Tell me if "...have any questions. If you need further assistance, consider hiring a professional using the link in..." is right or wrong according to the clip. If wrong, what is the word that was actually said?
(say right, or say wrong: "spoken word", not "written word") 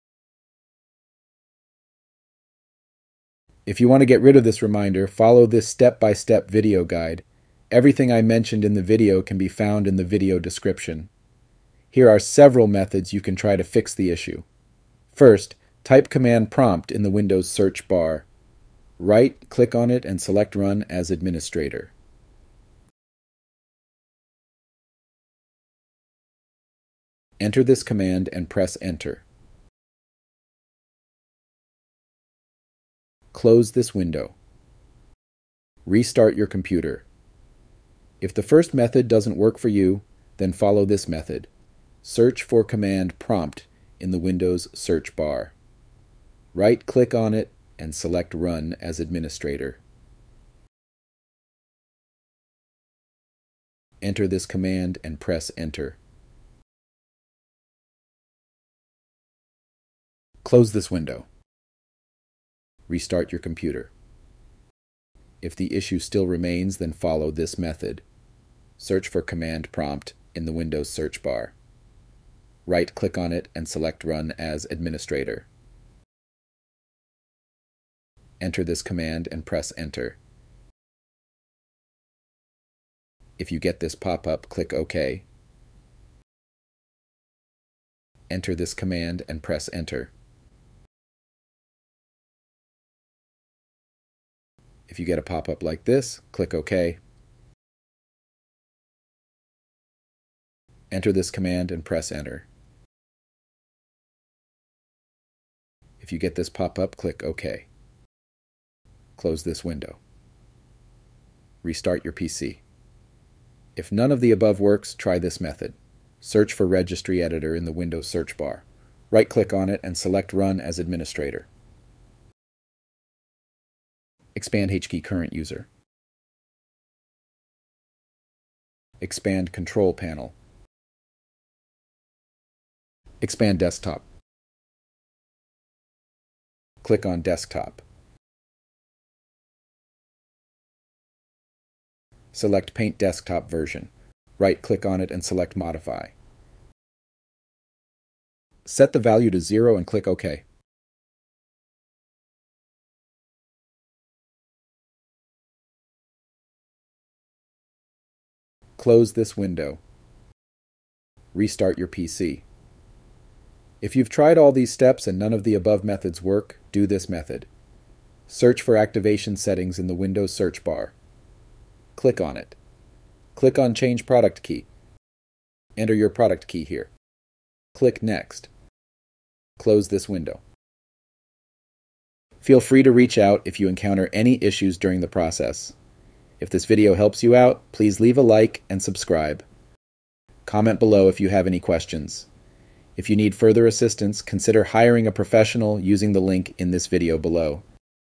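right.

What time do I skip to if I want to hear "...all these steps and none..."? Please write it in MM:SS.
02:44.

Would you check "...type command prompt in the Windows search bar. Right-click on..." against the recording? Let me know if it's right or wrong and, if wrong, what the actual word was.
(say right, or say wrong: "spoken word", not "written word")
right.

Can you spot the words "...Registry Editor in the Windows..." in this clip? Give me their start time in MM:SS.
01:56.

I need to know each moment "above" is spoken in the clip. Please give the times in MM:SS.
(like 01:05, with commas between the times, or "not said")
01:54, 02:45.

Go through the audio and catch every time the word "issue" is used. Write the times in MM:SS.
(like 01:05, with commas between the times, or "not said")
00:14, 01:05, 03:04.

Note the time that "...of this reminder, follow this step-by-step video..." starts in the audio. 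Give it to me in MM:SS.
00:04.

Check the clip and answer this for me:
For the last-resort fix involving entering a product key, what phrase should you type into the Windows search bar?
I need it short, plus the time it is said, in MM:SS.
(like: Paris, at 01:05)
activation settings, at 02:48.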